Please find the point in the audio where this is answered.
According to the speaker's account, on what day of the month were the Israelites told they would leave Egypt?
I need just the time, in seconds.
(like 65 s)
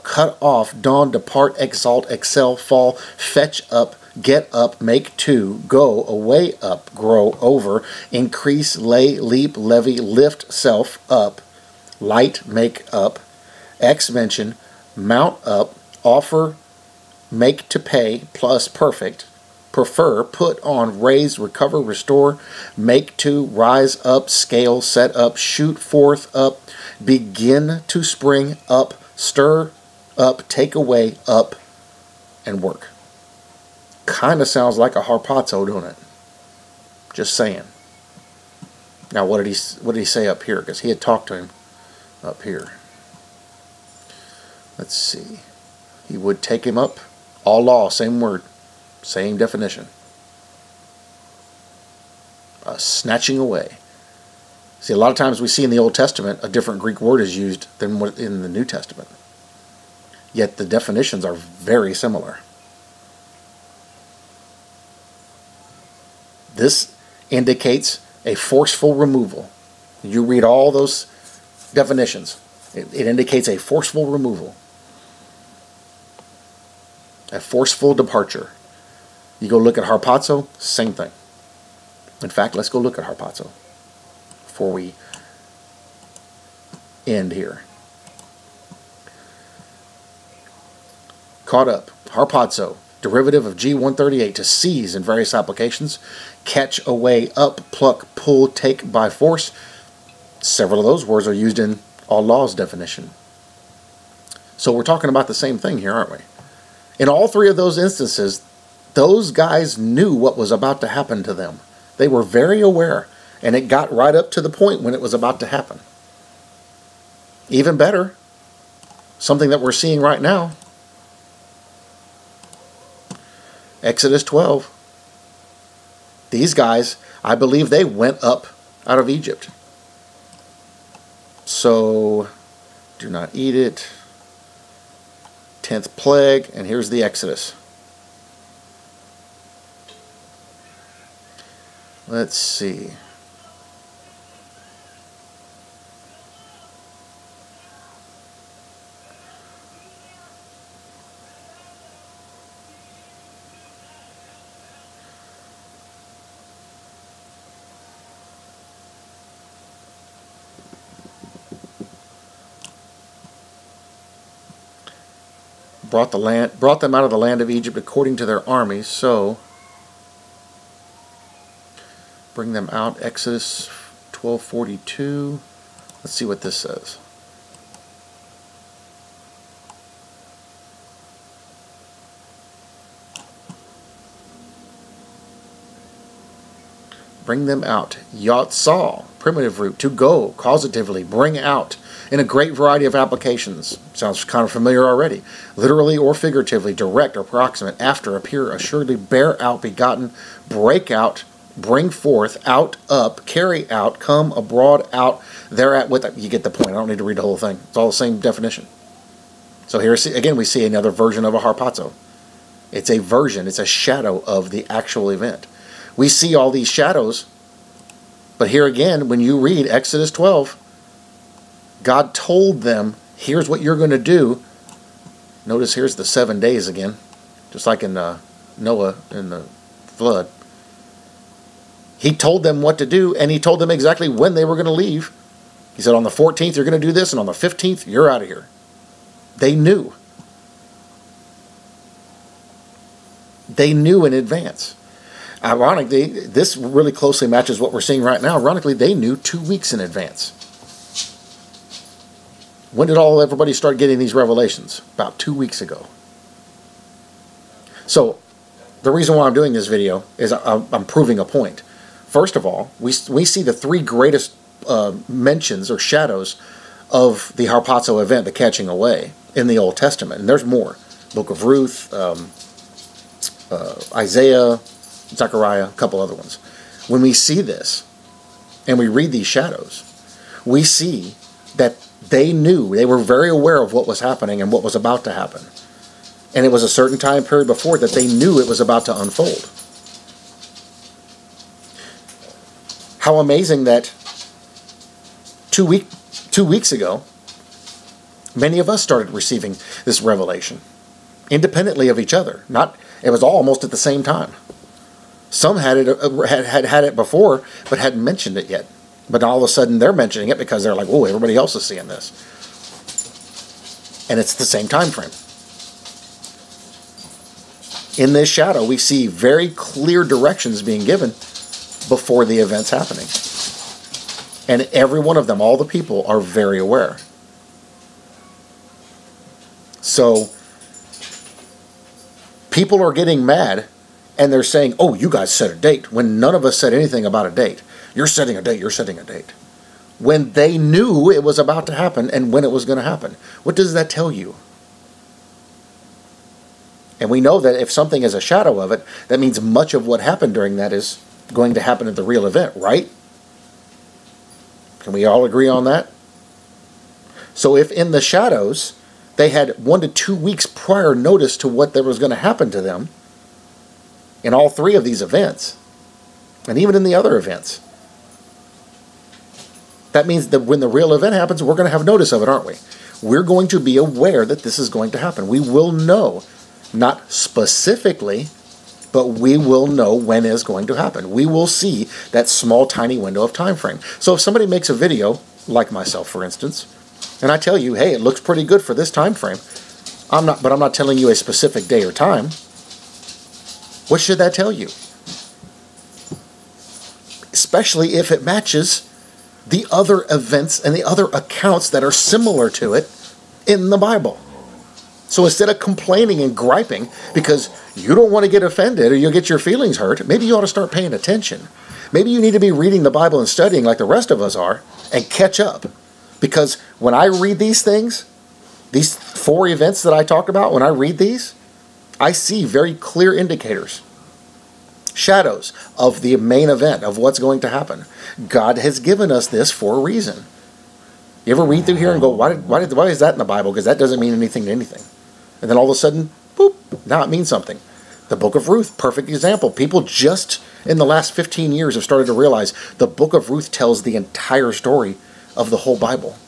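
237 s.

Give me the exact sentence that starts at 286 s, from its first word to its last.
And it was a certain time period before that they knew it was about to unfold.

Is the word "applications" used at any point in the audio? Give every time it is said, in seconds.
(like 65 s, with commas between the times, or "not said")
95 s, 192 s.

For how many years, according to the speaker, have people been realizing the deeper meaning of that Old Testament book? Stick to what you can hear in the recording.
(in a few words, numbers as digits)
15.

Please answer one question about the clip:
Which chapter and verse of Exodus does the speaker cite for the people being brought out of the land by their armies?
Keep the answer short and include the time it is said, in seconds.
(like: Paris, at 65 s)
Exodus 12:42, at 173 s.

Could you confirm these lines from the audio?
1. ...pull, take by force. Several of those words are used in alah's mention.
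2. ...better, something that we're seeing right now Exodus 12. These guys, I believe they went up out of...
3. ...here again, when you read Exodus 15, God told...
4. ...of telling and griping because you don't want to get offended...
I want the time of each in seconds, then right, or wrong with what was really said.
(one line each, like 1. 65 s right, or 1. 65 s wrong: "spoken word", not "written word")
1. 98 s wrong: "definition", not "mention"
2. 117 s right
3. 218 s wrong: "12", not "15"
4. 405 s wrong: "complaining", not "telling".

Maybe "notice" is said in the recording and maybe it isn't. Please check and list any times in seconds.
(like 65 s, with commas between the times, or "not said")
225 s, 360 s, 371 s.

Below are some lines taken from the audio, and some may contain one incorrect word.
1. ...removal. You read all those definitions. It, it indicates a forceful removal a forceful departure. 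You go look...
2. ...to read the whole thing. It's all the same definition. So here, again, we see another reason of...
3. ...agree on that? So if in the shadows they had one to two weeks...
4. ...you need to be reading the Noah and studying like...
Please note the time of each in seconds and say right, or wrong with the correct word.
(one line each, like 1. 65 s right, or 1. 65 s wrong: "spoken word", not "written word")
1. 68 s right
2. 206 s wrong: "version", not "reason"
3. 355 s right
4. 412 s wrong: "Bible", not "Noah".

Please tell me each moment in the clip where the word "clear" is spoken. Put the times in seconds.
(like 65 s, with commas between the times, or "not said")
319 s, 422 s.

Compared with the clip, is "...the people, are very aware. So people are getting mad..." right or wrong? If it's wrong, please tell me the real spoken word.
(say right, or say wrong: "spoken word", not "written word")
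right.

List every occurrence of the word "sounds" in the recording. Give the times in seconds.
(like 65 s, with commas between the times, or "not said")
34 s, 193 s.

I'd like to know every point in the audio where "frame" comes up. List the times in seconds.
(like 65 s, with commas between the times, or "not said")
314 s, 383 s, 389 s.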